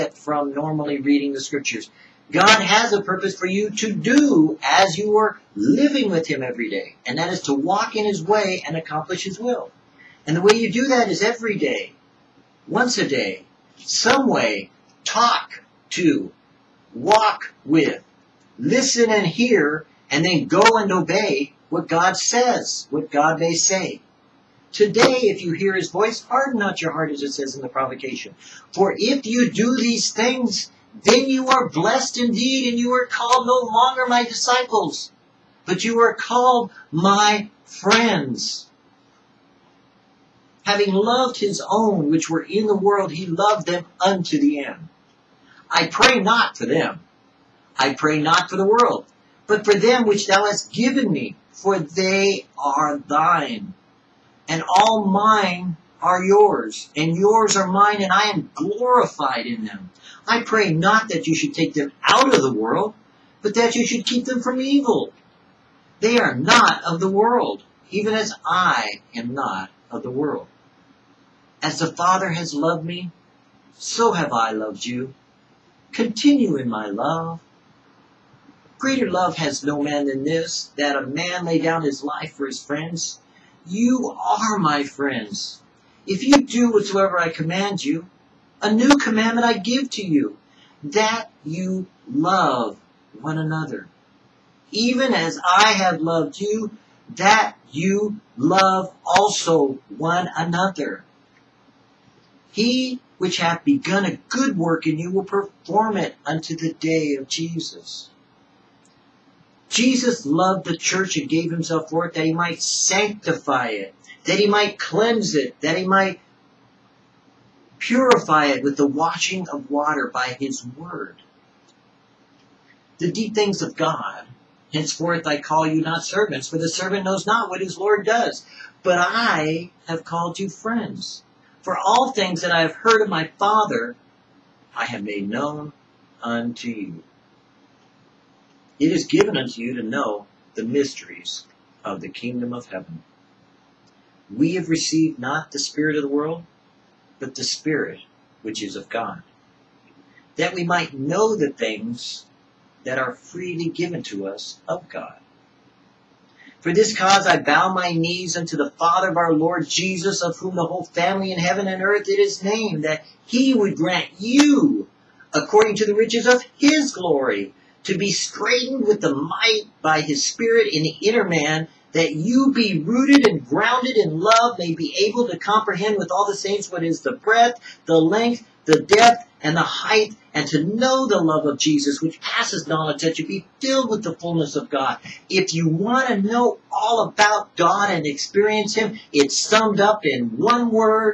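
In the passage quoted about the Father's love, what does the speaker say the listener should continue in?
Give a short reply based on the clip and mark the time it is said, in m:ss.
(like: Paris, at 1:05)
My love, at 1:15.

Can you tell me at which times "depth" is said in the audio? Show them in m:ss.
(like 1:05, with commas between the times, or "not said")
2:58.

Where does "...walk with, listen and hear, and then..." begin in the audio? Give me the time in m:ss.
0:16.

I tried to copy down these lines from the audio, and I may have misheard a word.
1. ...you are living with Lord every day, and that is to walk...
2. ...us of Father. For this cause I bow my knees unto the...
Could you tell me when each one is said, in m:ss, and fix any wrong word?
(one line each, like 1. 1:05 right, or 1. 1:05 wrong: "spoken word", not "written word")
1. 0:04 wrong: "Him", not "Lord"
2. 2:34 wrong: "God", not "Father".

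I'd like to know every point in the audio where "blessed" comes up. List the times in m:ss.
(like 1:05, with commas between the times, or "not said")
0:31.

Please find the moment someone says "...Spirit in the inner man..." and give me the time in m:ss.
2:50.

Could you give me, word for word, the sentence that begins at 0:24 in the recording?
Today, if you hear his voice, harden not your heart, as it says in the provocation.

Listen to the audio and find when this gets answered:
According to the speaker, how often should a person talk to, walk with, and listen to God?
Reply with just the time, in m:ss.
0:12.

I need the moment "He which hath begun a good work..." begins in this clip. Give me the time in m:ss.
1:42.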